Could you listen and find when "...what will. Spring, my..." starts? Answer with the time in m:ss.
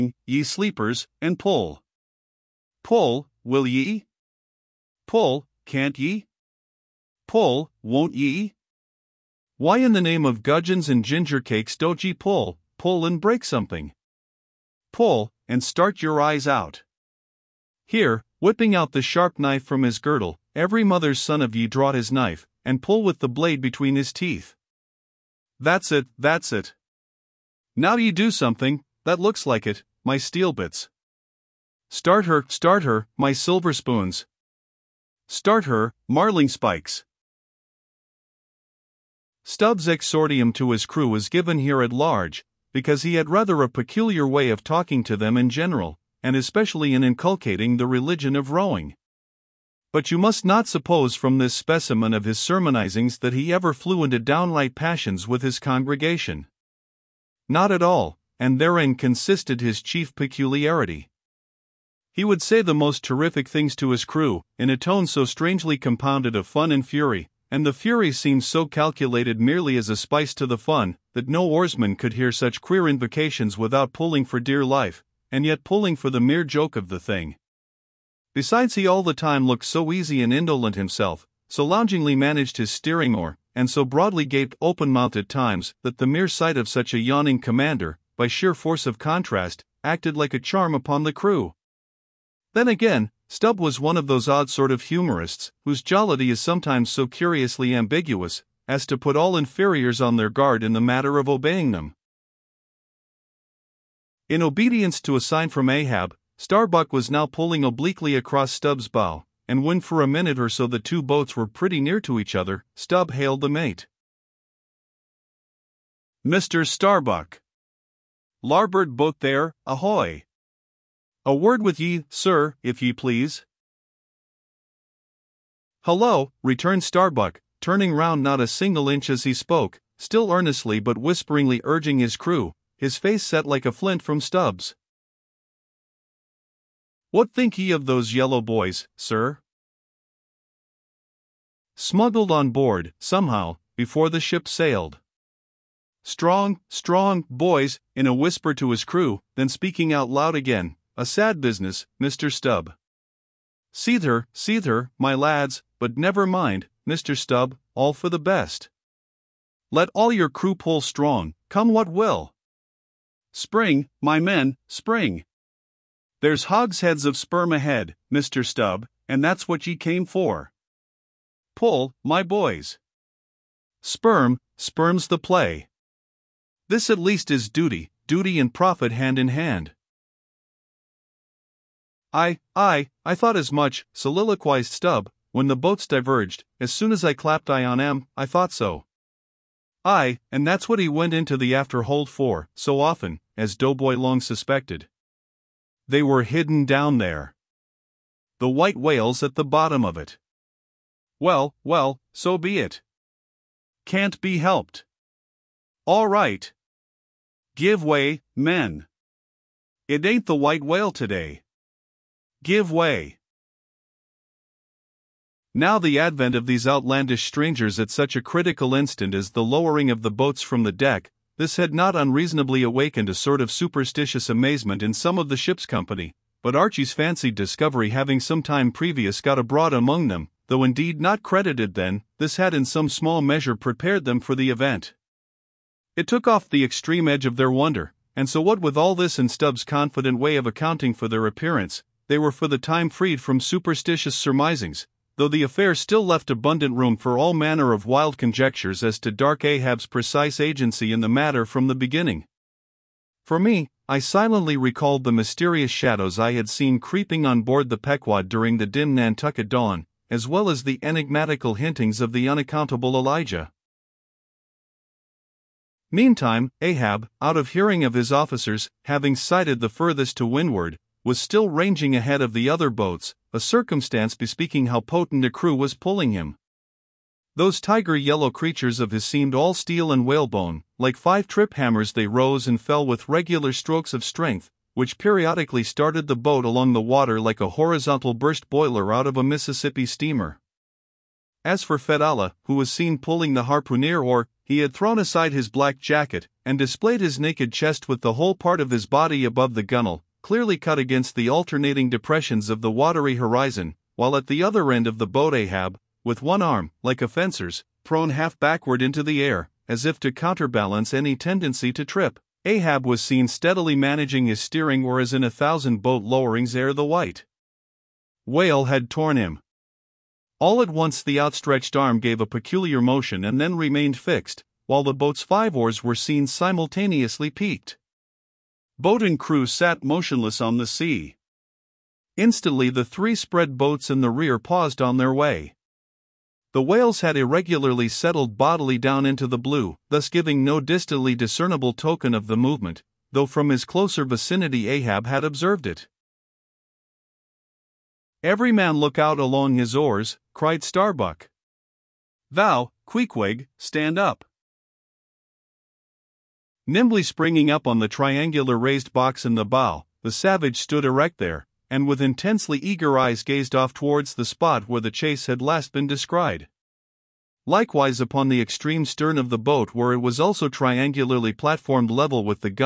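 2:41.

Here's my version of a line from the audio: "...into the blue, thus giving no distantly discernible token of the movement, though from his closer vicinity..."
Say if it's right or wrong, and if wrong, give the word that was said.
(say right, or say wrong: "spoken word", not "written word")
right.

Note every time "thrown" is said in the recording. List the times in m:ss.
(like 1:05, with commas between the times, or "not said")
4:54, 5:07.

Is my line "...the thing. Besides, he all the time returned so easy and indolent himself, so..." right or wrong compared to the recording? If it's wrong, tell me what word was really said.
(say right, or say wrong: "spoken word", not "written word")
wrong: "looked", not "returned".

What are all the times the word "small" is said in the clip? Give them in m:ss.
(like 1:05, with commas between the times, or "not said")
3:52.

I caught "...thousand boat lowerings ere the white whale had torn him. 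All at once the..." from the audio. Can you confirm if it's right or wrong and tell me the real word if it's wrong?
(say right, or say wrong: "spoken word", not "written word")
right.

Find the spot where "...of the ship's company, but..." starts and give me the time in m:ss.
3:45.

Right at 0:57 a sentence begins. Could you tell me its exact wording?
Not at all, and therein consisted his chief peculiarity.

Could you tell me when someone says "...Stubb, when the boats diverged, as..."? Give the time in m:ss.
3:04.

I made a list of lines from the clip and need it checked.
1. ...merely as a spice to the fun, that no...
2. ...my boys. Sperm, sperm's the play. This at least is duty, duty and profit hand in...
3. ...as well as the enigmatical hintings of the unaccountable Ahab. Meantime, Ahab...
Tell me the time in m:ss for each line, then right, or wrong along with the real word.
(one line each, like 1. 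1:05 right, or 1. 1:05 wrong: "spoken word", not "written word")
1. 1:09 right
2. 2:52 right
3. 4:20 wrong: "Elijah", not "Ahab".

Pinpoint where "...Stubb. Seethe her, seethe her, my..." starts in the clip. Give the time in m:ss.
2:32.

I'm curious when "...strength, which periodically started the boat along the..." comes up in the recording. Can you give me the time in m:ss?
4:44.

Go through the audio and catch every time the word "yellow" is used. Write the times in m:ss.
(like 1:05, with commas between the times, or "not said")
2:18, 4:37.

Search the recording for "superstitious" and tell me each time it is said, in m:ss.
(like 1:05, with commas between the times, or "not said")
3:43, 4:03.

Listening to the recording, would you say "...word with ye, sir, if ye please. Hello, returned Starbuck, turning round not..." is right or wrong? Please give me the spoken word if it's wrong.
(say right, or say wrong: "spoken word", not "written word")
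right.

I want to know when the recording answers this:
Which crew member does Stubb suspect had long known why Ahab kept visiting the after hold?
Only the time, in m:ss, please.
3:13.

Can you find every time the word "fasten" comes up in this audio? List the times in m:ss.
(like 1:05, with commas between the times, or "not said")
not said.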